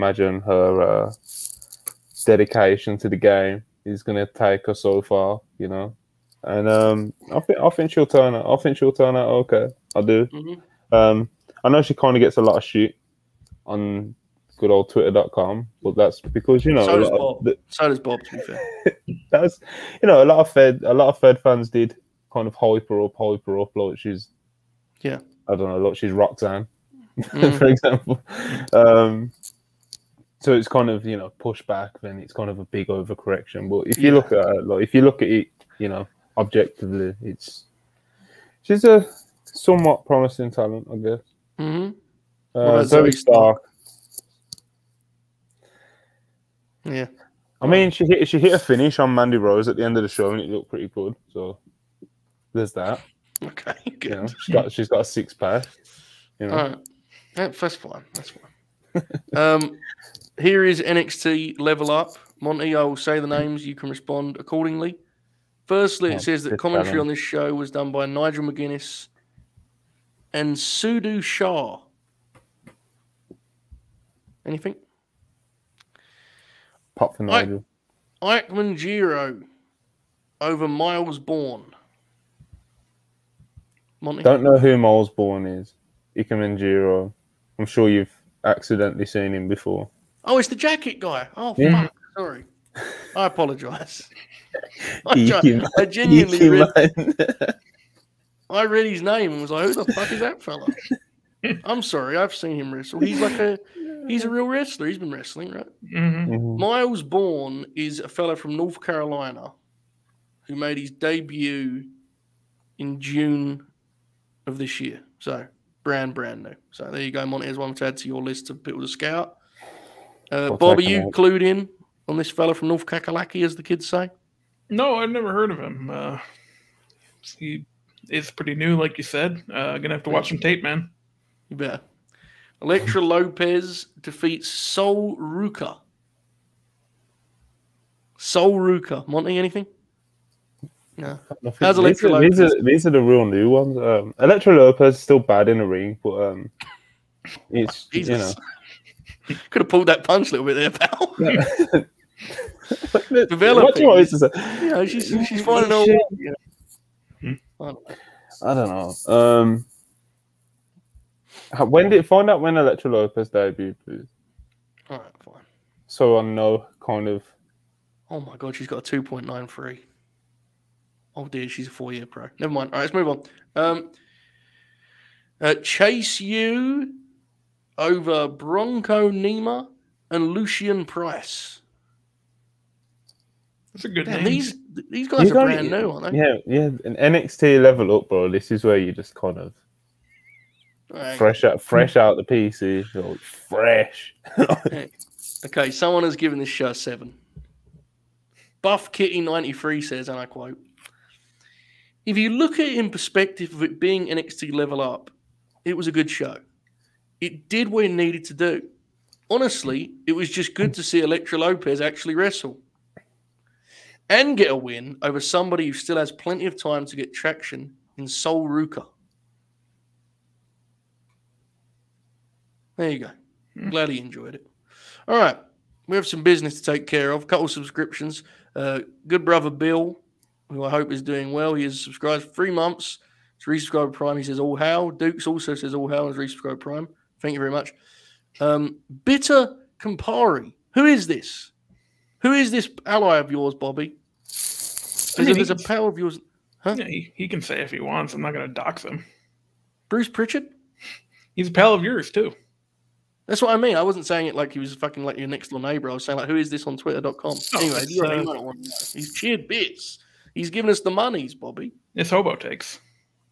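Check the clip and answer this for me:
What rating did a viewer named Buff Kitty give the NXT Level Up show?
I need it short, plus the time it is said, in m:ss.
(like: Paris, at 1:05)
7, at 3:16.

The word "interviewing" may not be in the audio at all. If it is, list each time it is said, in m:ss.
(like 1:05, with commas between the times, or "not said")
not said.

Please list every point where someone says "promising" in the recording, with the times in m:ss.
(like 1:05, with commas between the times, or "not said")
0:40.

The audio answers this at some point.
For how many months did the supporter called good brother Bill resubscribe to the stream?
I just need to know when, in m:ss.
3:52.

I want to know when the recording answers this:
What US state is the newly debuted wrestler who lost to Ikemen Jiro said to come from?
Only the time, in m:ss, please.
1:48.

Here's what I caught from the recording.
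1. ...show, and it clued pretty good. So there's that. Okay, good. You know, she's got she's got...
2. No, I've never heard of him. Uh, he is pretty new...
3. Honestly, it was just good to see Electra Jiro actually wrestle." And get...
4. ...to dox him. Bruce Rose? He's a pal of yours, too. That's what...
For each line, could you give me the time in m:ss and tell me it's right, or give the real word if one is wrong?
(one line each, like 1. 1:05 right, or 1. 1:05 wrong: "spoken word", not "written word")
1. 0:50 wrong: "looked", not "clued"
2. 2:04 right
3. 3:29 wrong: "Lopez", not "Jiro"
4. 4:08 wrong: "Pritchard", not "Rose".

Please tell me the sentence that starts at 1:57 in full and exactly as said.
One to add to your list of people to scout.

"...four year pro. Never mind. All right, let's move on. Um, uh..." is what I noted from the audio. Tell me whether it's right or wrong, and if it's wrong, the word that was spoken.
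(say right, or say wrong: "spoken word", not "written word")
right.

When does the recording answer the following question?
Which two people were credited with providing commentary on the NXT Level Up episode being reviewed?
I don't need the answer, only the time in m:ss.
1:08.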